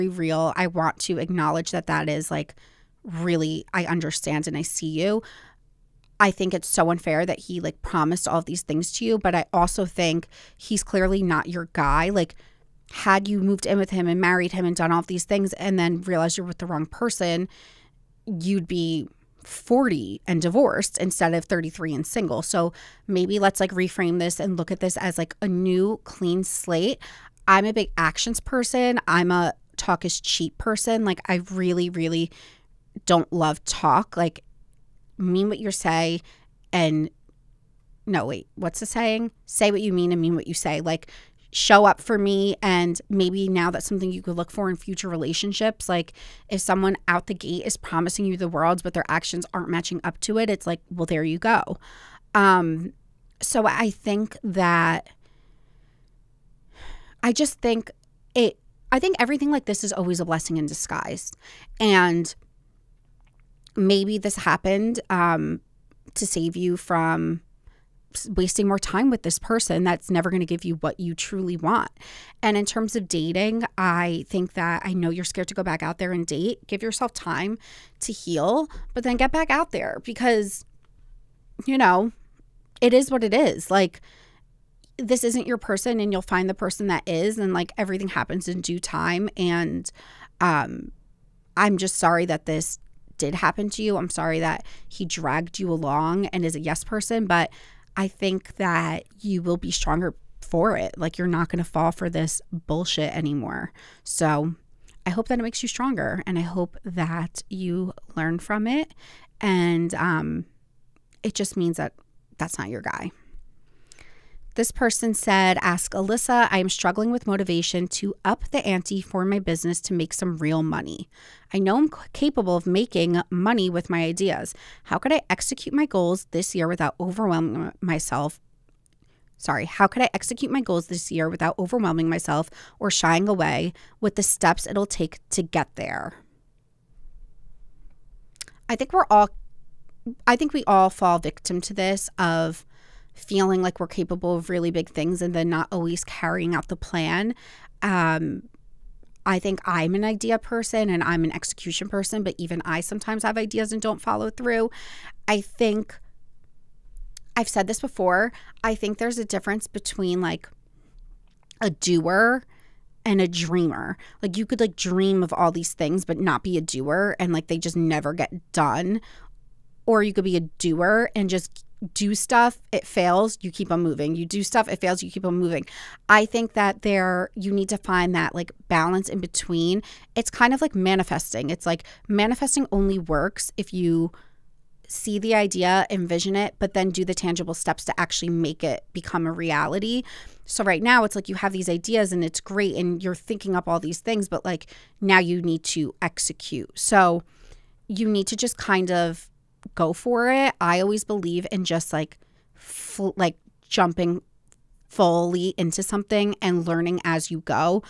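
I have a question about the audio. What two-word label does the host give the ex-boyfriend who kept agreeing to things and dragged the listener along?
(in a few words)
yes person.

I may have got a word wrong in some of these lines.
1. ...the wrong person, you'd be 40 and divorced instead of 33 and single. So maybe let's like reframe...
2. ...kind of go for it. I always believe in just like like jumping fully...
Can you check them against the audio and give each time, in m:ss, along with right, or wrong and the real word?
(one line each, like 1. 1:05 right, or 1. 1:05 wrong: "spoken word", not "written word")
1. 0:16 right
2. 3:18 right.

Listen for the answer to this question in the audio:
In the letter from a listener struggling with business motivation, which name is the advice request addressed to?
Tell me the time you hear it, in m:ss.
1:55.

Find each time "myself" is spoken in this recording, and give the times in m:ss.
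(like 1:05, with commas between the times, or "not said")
2:07, 2:12.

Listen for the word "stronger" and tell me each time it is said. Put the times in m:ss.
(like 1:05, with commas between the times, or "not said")
1:39, 1:45.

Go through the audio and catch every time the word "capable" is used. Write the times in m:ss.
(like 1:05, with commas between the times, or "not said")
2:02, 2:23.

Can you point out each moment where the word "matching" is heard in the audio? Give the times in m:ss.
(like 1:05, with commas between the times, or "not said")
0:49.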